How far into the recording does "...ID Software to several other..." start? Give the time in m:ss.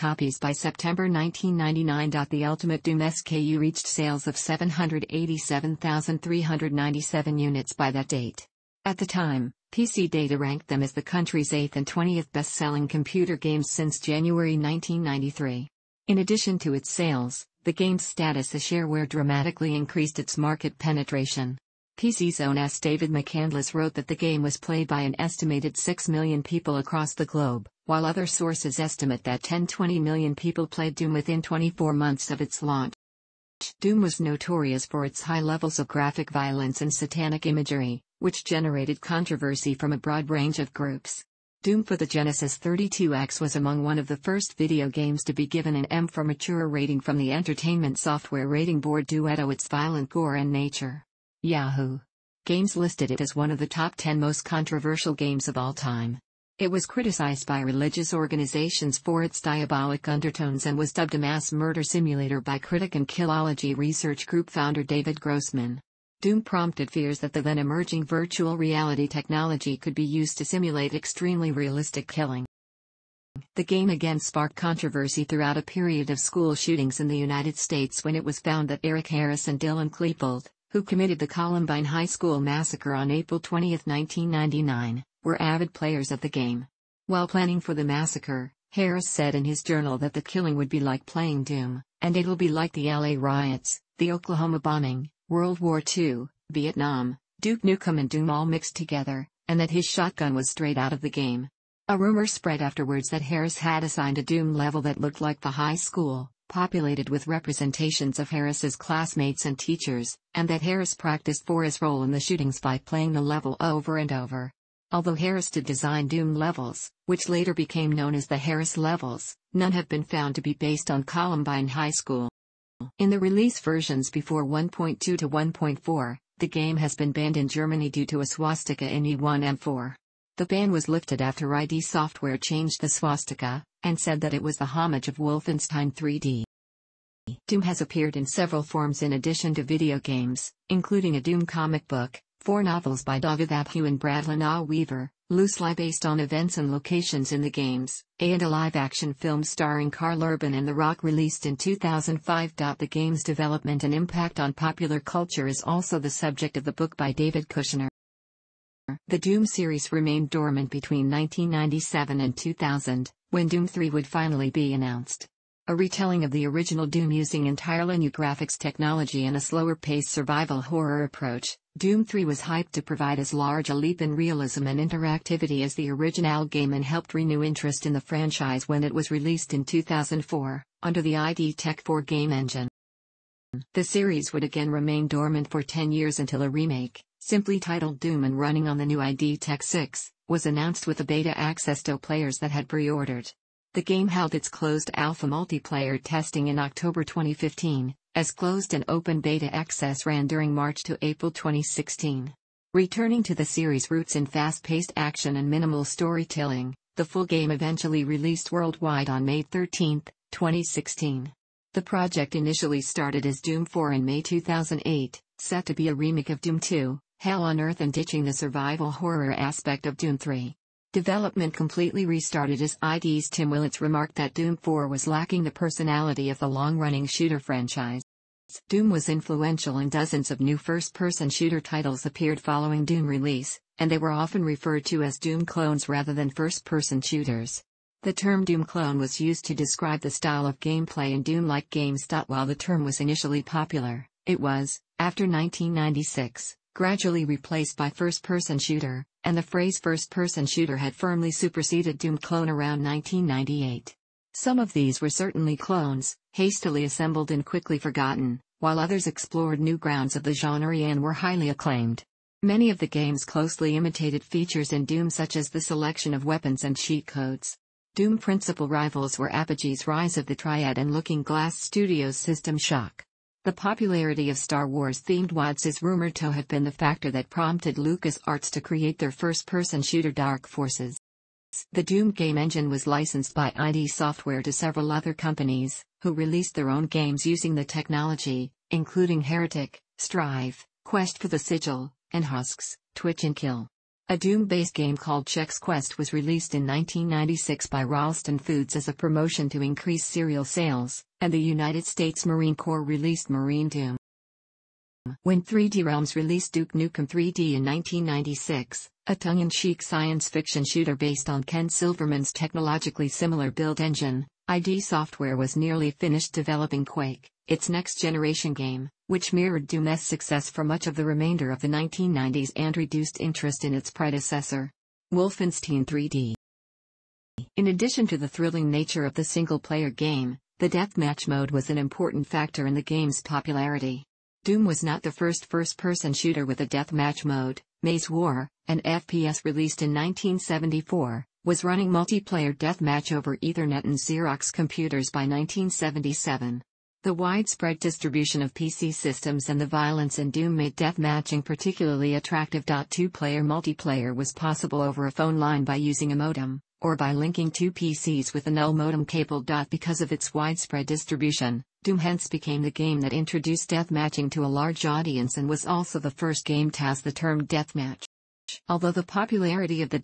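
4:43.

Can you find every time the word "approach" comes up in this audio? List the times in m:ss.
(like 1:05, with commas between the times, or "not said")
2:51.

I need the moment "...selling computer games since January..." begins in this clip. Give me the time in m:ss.
0:12.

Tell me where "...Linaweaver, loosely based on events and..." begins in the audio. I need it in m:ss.
2:24.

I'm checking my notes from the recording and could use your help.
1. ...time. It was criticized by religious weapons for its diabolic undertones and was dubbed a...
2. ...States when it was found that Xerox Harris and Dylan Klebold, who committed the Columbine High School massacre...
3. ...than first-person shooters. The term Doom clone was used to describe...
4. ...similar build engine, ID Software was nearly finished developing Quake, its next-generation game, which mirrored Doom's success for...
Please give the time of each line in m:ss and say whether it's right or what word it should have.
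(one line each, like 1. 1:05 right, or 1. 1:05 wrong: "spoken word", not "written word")
1. 0:55 wrong: "organizations", not "weapons"
2. 1:17 wrong: "Eric", not "Xerox"
3. 3:56 right
4. 5:13 right.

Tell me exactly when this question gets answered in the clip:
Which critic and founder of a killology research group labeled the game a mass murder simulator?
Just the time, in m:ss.
1:04.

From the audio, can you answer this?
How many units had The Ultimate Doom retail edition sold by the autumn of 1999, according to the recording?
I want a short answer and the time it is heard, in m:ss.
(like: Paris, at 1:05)
787,397, at 0:04.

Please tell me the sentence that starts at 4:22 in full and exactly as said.
Many of the games closely imitated features in Doom such as the selection of weapons and cheat codes.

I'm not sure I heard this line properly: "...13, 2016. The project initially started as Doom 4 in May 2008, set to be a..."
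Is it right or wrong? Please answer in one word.
right.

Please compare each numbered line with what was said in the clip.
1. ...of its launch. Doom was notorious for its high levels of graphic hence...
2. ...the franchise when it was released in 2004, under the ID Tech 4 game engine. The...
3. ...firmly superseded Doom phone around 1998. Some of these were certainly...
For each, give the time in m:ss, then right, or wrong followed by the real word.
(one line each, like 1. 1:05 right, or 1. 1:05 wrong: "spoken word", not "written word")
1. 0:32 wrong: "violence", not "hence"
2. 2:57 right
3. 4:10 wrong: "clone", not "phone".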